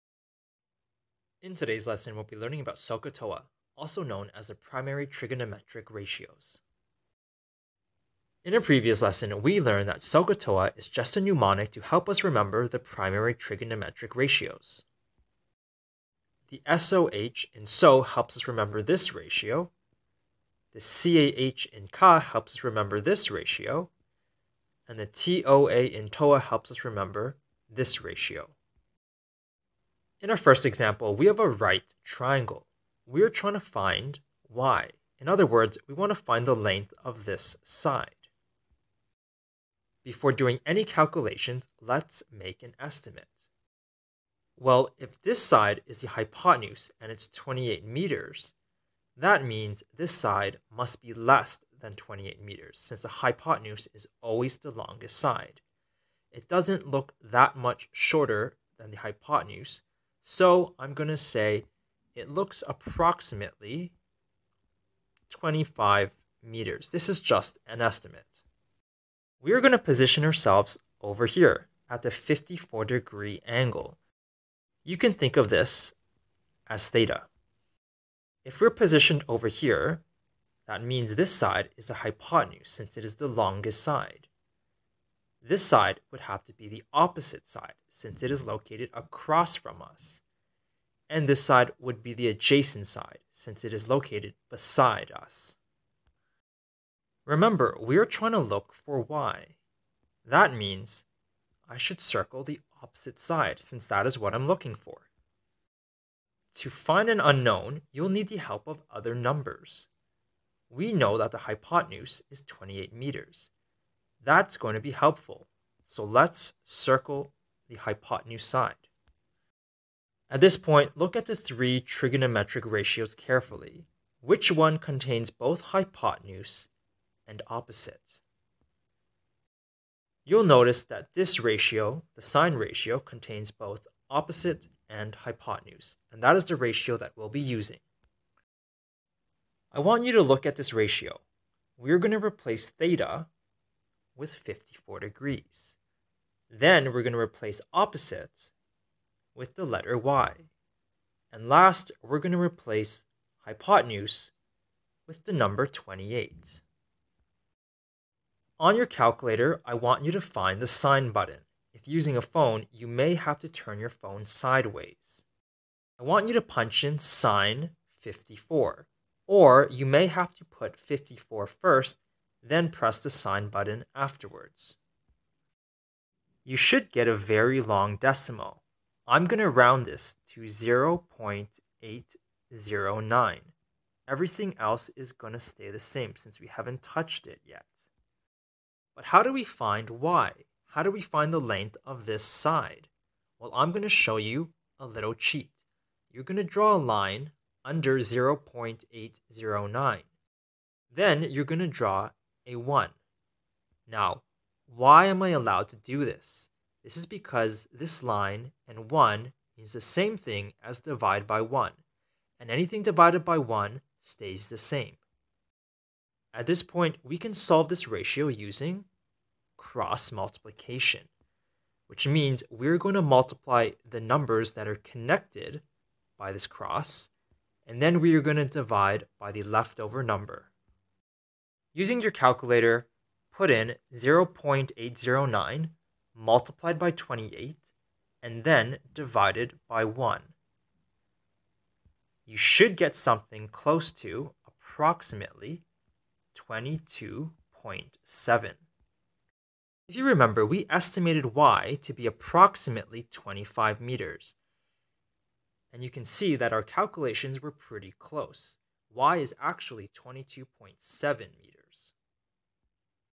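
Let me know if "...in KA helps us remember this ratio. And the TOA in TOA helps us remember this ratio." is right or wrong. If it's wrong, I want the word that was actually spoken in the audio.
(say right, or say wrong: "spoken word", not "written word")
right.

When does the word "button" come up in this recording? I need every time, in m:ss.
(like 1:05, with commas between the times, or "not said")
2:41, 2:53.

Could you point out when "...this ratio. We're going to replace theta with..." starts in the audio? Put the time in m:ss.
2:20.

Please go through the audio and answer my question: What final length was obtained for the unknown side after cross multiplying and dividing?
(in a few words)
22.7 meters.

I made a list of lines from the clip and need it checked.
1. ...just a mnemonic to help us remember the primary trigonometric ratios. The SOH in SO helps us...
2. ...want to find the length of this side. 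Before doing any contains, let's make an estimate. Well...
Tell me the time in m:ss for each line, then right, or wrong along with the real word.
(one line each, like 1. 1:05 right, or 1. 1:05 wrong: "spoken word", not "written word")
1. 0:10 right
2. 0:35 wrong: "calculations", not "contains".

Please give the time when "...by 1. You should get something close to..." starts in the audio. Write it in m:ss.
3:59.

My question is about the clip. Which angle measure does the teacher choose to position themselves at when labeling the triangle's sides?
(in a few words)
54 degrees.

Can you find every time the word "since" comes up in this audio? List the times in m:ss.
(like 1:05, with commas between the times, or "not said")
0:52, 1:22, 1:27, 1:33, 1:43, 3:06.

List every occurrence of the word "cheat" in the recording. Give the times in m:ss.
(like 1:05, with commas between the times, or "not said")
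3:15.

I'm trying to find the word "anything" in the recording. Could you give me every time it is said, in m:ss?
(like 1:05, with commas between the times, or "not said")
3:32.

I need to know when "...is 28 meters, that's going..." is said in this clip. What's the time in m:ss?
1:52.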